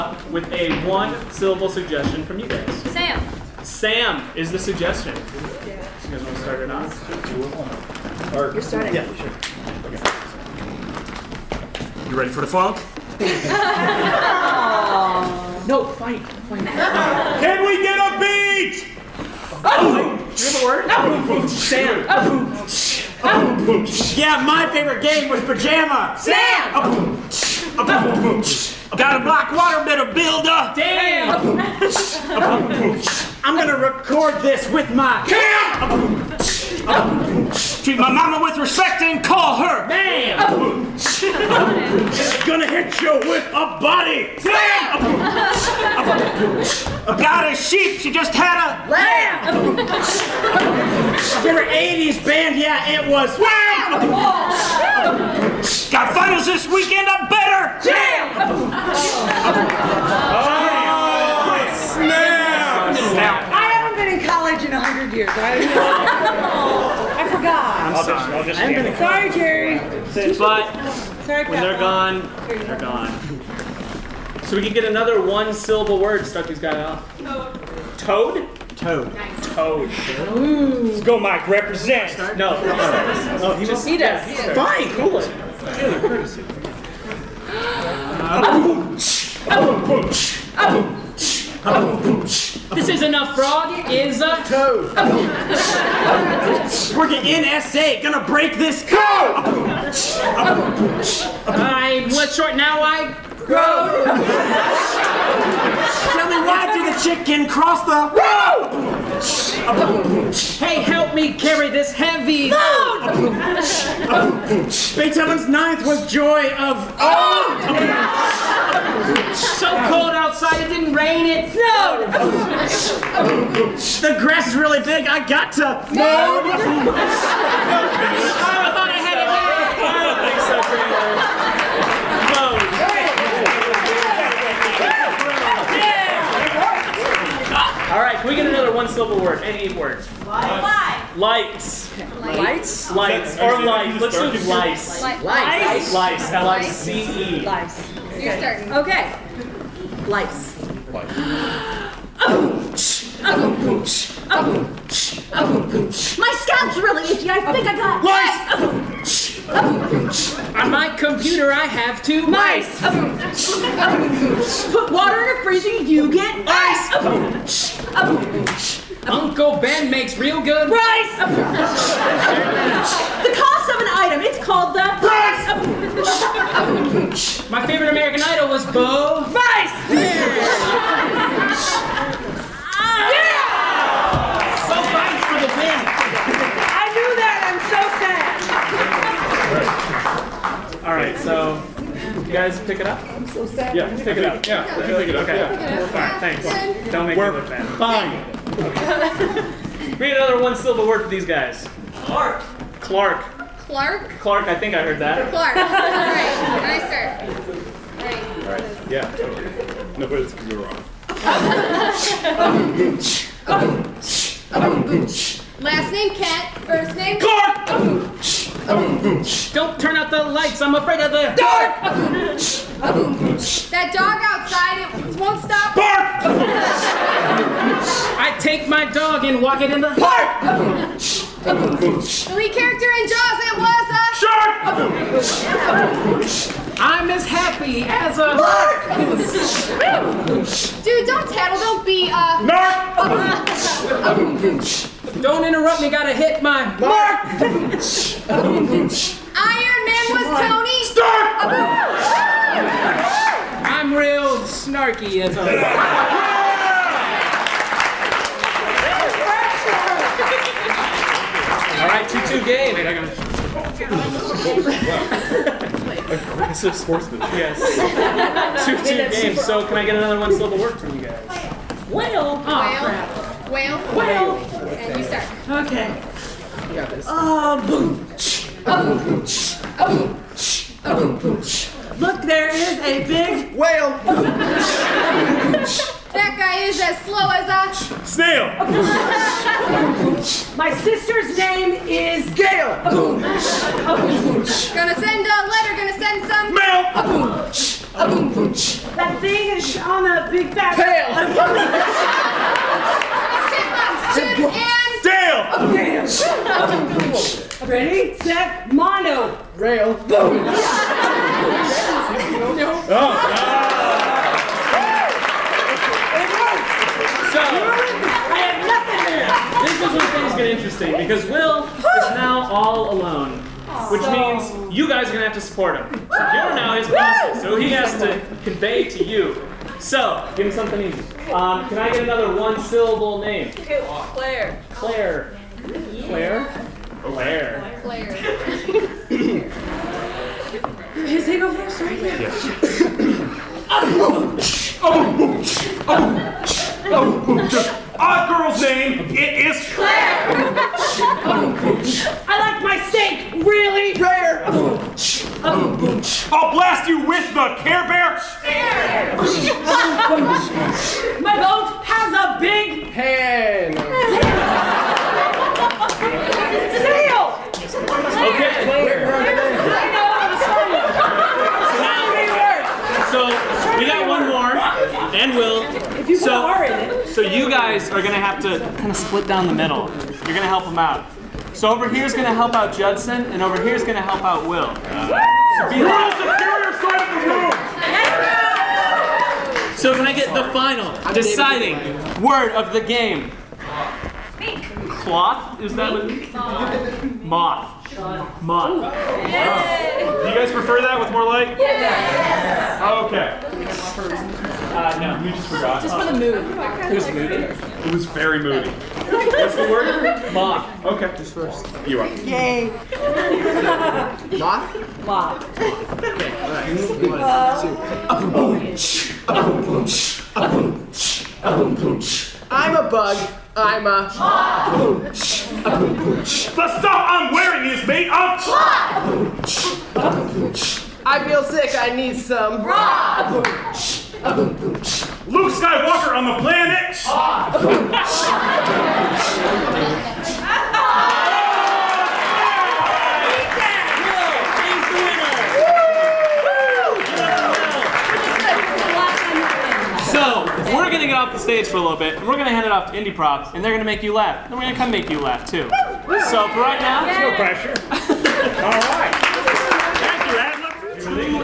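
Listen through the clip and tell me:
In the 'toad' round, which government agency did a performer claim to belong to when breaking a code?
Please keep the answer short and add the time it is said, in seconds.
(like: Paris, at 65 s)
NSA, at 97 s.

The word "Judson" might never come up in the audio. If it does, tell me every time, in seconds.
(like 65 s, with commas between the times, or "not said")
382 s.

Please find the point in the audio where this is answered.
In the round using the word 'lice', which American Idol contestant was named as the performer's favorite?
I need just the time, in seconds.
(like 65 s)
178 s.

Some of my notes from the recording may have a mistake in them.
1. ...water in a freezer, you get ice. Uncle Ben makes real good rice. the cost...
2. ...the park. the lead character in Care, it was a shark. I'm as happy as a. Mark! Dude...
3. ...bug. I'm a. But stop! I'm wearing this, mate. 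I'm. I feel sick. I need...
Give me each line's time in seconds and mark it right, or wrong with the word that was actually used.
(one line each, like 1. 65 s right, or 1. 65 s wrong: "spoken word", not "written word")
1. 164 s right
2. 229 s wrong: "Jaws", not "Care"
3. 422 s right.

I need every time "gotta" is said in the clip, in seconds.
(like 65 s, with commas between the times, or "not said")
245 s, 262 s.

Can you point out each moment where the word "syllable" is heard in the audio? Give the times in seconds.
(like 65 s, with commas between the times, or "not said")
1 s, 75 s, 138 s, 200 s, 332 s.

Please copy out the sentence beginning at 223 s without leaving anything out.
that dog outside, it won't stop.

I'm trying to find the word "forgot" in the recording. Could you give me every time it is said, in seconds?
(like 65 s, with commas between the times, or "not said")
67 s, 405 s.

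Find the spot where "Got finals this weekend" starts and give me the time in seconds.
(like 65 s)
55 s.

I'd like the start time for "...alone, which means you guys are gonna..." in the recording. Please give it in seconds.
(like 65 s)
322 s.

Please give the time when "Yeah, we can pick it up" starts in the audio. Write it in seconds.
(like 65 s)
194 s.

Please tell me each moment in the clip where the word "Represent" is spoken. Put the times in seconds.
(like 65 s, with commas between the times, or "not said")
81 s.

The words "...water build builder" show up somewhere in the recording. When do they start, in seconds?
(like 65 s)
29 s.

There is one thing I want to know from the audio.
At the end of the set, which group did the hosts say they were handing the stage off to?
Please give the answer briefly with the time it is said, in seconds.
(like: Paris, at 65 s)
IndyProv, at 453 s.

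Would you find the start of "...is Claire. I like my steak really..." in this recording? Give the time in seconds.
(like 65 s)
349 s.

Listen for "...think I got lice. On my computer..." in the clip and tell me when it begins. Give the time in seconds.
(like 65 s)
157 s.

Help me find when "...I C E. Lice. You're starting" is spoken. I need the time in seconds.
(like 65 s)
146 s.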